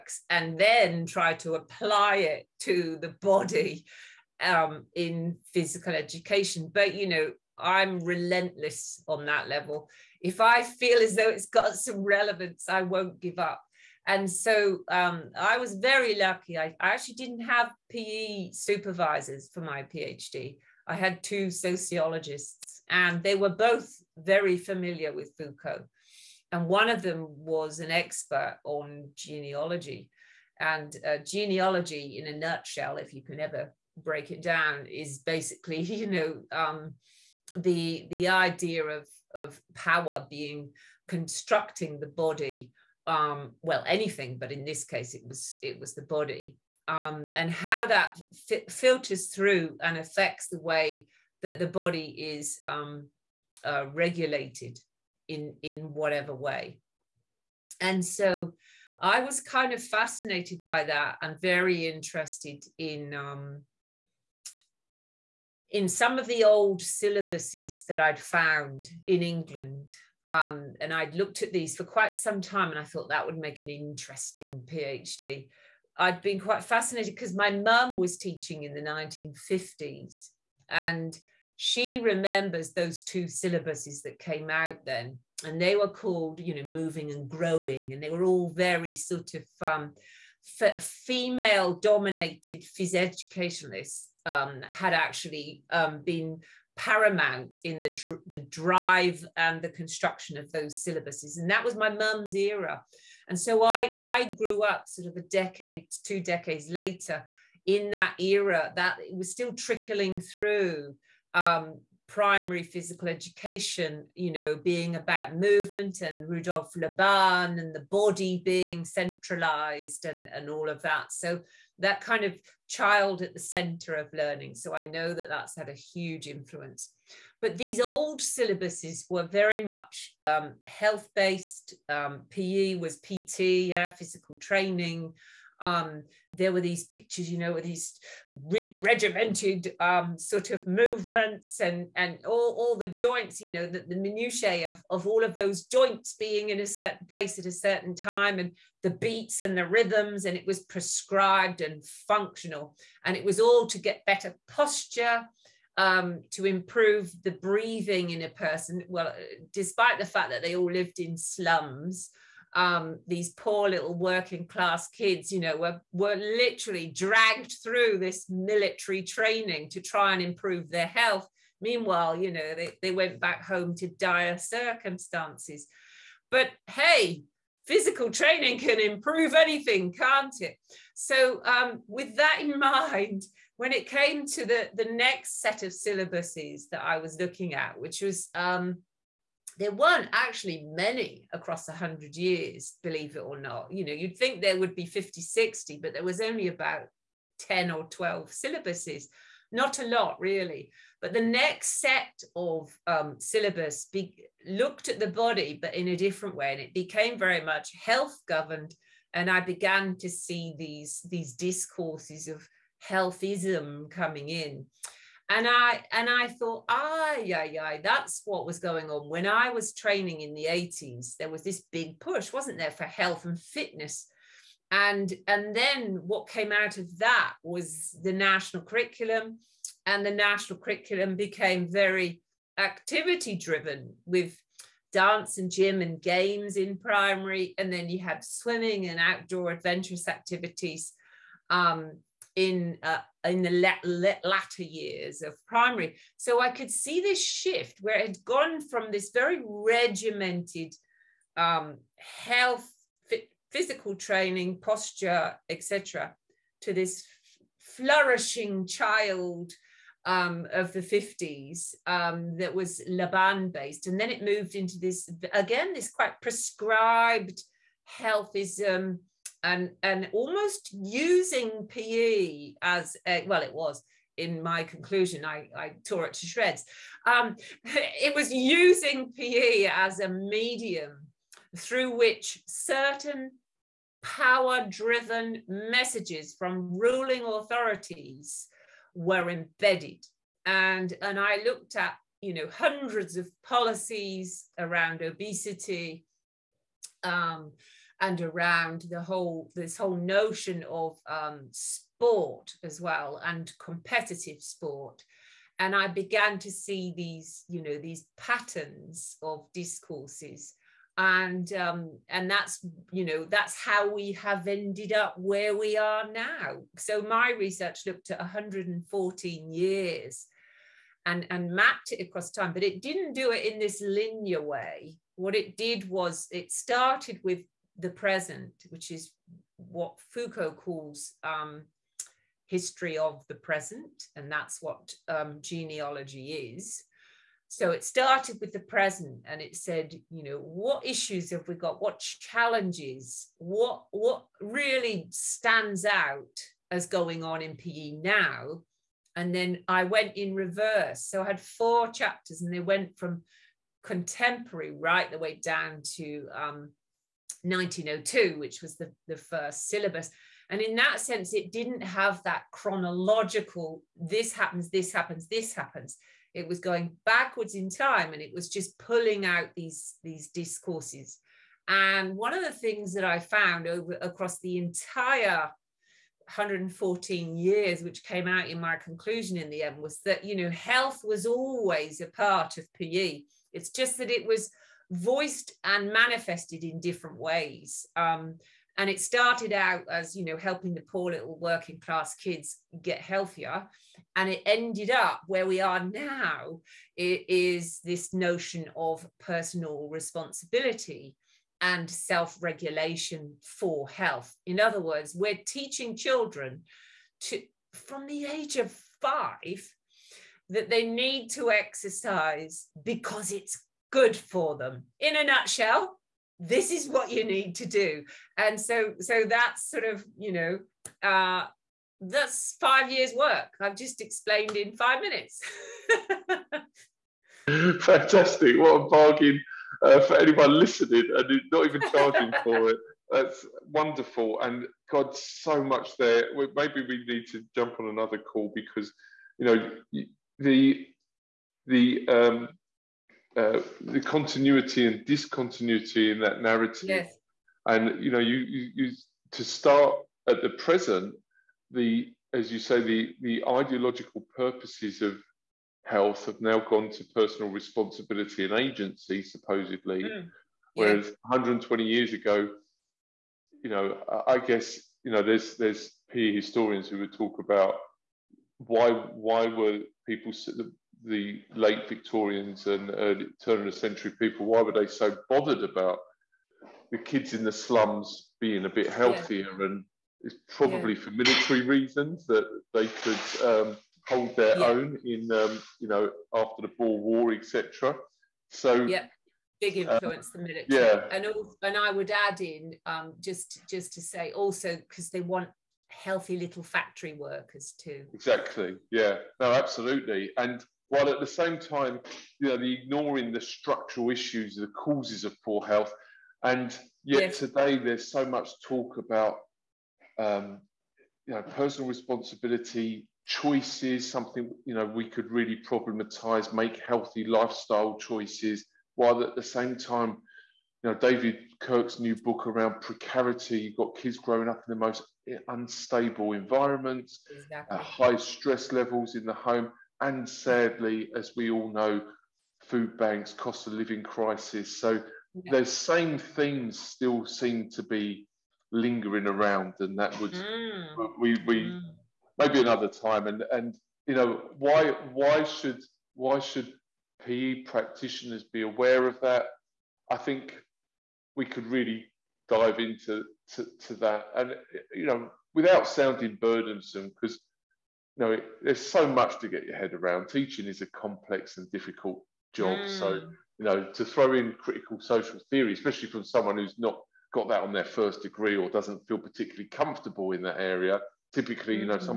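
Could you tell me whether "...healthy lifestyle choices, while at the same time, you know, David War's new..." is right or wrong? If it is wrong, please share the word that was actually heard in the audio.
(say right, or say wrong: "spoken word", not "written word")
wrong: "Kirk", not "War".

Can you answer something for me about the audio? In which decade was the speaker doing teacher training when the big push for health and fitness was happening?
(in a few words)
The 80s.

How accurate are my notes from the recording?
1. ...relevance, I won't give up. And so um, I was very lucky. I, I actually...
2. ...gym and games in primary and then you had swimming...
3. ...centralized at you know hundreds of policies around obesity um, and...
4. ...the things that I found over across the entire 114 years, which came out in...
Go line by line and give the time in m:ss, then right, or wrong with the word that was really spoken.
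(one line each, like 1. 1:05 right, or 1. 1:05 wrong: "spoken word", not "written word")
1. 0:12 right
2. 3:55 right
3. 4:51 wrong: "looked", not "centralized"
4. 6:12 right.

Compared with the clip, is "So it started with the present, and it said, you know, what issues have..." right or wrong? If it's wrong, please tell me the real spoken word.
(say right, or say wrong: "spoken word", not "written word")
right.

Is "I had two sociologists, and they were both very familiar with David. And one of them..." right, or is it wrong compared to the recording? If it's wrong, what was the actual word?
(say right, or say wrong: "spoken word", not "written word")
wrong: "Foucault", not "David".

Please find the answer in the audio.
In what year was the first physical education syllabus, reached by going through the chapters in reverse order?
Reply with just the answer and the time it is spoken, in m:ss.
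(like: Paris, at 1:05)
1902, at 5:57.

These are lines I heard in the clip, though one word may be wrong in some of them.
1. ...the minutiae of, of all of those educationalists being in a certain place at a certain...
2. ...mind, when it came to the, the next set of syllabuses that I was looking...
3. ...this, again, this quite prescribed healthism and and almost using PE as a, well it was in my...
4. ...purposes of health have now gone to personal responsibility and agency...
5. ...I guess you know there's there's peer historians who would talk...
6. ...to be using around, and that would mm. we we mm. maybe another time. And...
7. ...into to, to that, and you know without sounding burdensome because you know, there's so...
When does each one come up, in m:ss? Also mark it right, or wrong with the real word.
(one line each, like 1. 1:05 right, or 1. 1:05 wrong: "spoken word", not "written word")
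1. 2:23 wrong: "joints", not "educationalists"
2. 3:02 right
3. 4:24 right
4. 7:34 right
5. 7:44 right
6. 8:57 wrong: "lingering", not "using"
7. 9:12 right.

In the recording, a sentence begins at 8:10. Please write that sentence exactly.
Yeah, and also, and I would add in um, just just to say also because they want healthy little factory workers too.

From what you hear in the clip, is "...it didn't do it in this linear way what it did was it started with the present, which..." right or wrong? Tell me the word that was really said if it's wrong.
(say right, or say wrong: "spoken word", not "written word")
right.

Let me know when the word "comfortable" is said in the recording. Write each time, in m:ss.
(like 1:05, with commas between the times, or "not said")
9:29.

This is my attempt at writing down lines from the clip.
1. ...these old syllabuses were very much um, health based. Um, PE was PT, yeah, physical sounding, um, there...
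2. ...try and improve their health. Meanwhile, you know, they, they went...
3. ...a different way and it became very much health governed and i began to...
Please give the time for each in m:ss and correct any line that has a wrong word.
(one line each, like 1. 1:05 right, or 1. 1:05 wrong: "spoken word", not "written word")
1. 2:07 wrong: "training", not "sounding"
2. 2:49 right
3. 3:25 right.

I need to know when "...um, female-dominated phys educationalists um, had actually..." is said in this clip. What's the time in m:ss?
1:29.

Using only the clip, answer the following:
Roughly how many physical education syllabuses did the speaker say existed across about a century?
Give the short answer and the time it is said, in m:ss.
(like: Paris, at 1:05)
10 or 12, at 3:17.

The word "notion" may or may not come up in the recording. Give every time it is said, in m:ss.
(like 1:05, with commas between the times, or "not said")
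4:59, 6:38.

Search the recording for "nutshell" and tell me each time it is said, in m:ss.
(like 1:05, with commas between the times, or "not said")
0:32, 6:55.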